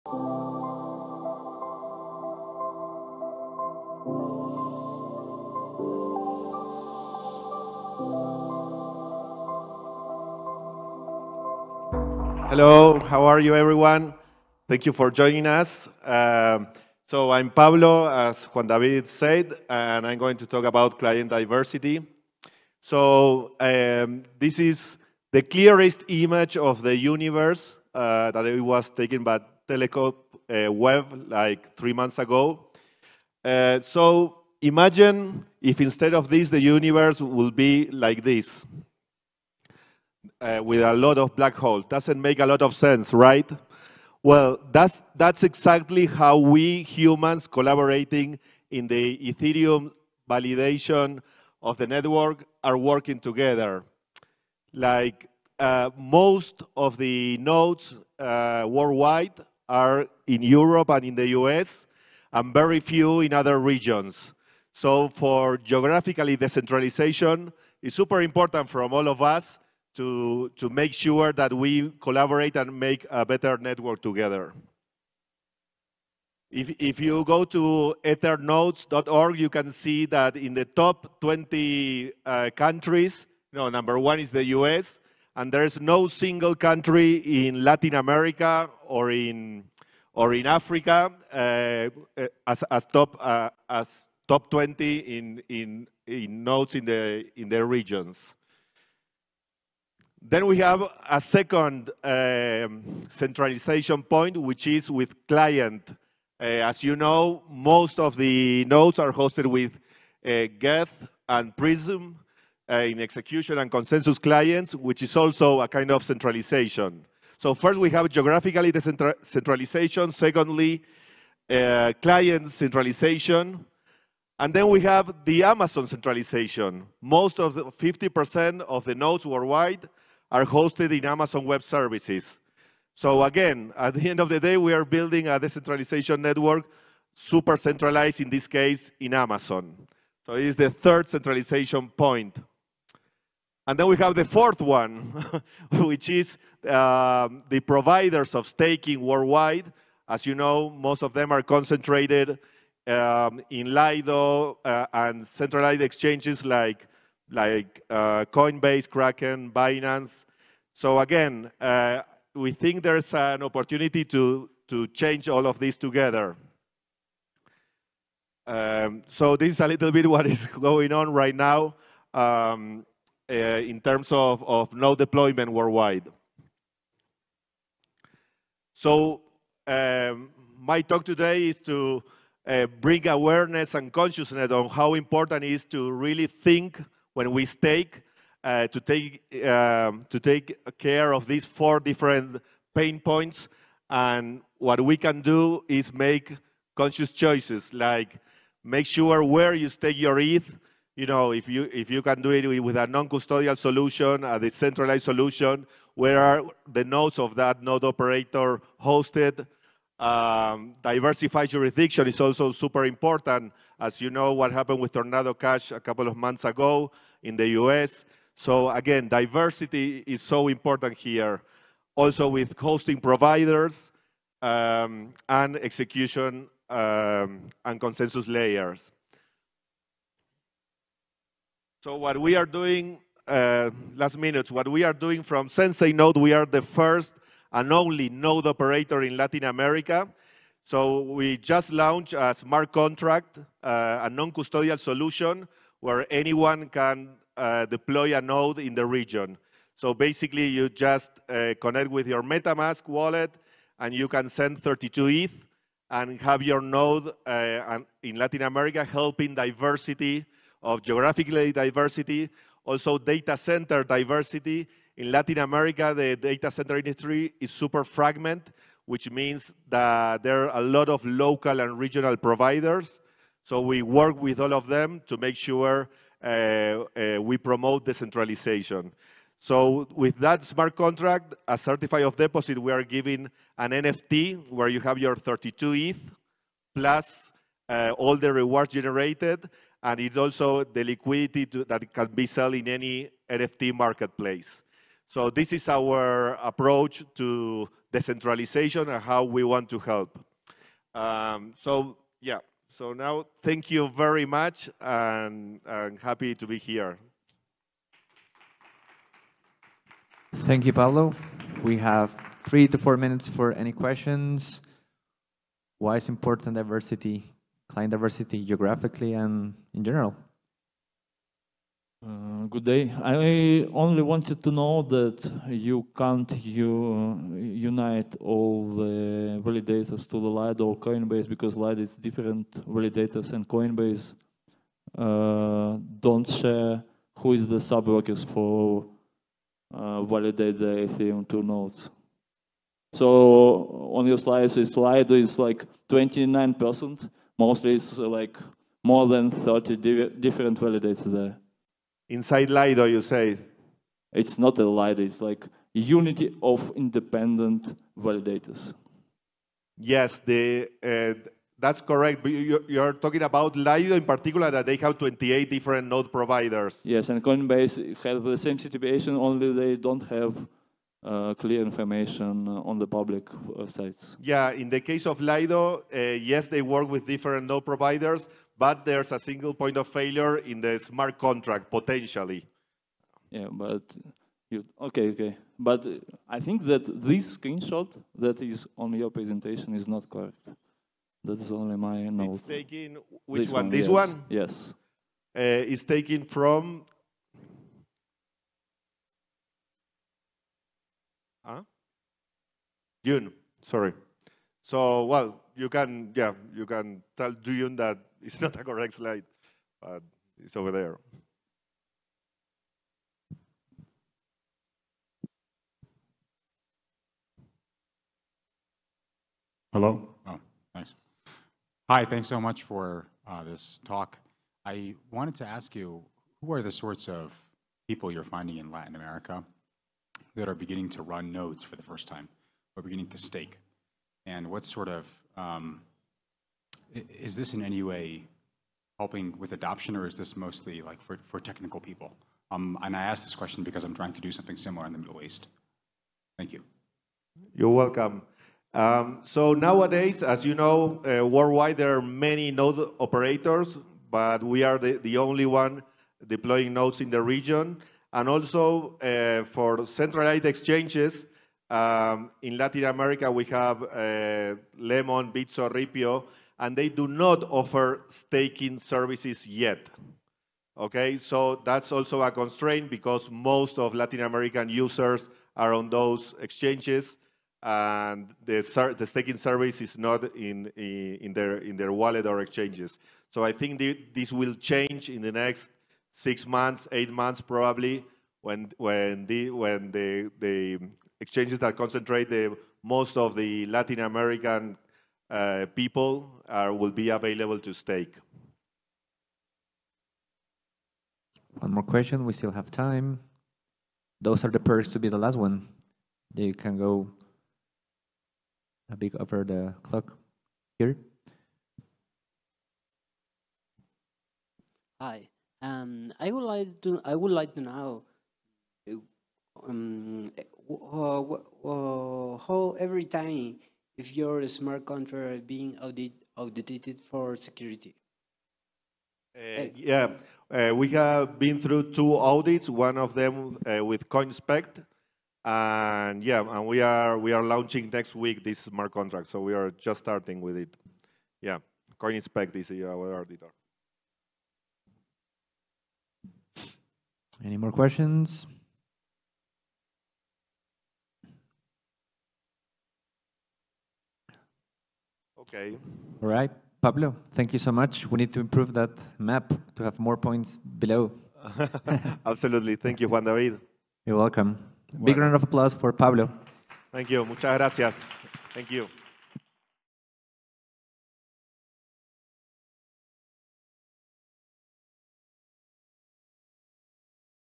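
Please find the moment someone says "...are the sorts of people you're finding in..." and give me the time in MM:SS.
07:06.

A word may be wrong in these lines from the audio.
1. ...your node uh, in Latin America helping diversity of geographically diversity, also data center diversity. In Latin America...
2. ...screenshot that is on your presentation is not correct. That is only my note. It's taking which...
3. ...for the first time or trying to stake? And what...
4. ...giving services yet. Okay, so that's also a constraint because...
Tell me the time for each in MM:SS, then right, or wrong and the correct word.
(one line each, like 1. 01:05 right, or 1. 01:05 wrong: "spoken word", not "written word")
1. 04:16 right
2. 06:27 right
3. 07:11 wrong: "beginning", not "trying"
4. 07:48 wrong: "staking", not "giving".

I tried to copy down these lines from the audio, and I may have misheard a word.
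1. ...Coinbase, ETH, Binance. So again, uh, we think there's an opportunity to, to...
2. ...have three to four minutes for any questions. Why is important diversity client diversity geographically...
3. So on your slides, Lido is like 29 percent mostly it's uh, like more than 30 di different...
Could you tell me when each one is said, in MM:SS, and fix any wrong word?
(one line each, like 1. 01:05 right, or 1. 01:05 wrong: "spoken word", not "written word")
1. 02:38 wrong: "Kraken", not "ETH"
2. 05:11 right
3. 05:42 right.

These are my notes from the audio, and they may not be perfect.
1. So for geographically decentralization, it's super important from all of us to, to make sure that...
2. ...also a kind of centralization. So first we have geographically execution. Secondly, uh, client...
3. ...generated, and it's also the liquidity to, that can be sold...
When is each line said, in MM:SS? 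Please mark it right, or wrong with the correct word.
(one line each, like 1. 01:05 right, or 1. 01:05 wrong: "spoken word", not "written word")
1. 01:04 right
2. 01:55 wrong: "decentralization", not "execution"
3. 04:48 right.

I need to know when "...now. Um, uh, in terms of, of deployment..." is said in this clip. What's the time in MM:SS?
02:51.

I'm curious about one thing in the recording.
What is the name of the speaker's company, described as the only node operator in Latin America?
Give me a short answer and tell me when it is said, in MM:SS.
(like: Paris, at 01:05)
Sensei Node, at 03:55.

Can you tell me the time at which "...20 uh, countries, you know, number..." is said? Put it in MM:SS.
01:21.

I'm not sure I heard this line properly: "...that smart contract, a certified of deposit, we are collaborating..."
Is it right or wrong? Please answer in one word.
wrong.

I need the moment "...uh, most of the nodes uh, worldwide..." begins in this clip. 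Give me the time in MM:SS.
00:55.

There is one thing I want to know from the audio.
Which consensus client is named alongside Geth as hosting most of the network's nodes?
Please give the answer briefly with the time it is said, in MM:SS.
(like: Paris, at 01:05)
Prism, at 01:51.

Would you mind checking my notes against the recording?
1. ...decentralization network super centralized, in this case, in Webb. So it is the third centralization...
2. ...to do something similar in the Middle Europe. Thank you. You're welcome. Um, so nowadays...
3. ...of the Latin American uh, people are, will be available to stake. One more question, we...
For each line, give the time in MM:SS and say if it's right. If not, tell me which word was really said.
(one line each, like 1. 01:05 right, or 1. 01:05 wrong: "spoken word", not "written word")
1. 02:15 wrong: "Amazon", not "Webb"
2. 07:24 wrong: "East", not "Europe"
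3. 08:13 right.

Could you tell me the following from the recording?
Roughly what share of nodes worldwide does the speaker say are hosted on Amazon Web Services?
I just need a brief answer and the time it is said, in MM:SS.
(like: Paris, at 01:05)
50%, at 02:07.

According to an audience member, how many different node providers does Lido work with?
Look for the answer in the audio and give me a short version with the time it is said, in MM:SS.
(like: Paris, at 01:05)
28, at 06:04.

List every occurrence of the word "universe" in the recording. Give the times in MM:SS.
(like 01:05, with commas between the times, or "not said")
00:26, 00:36.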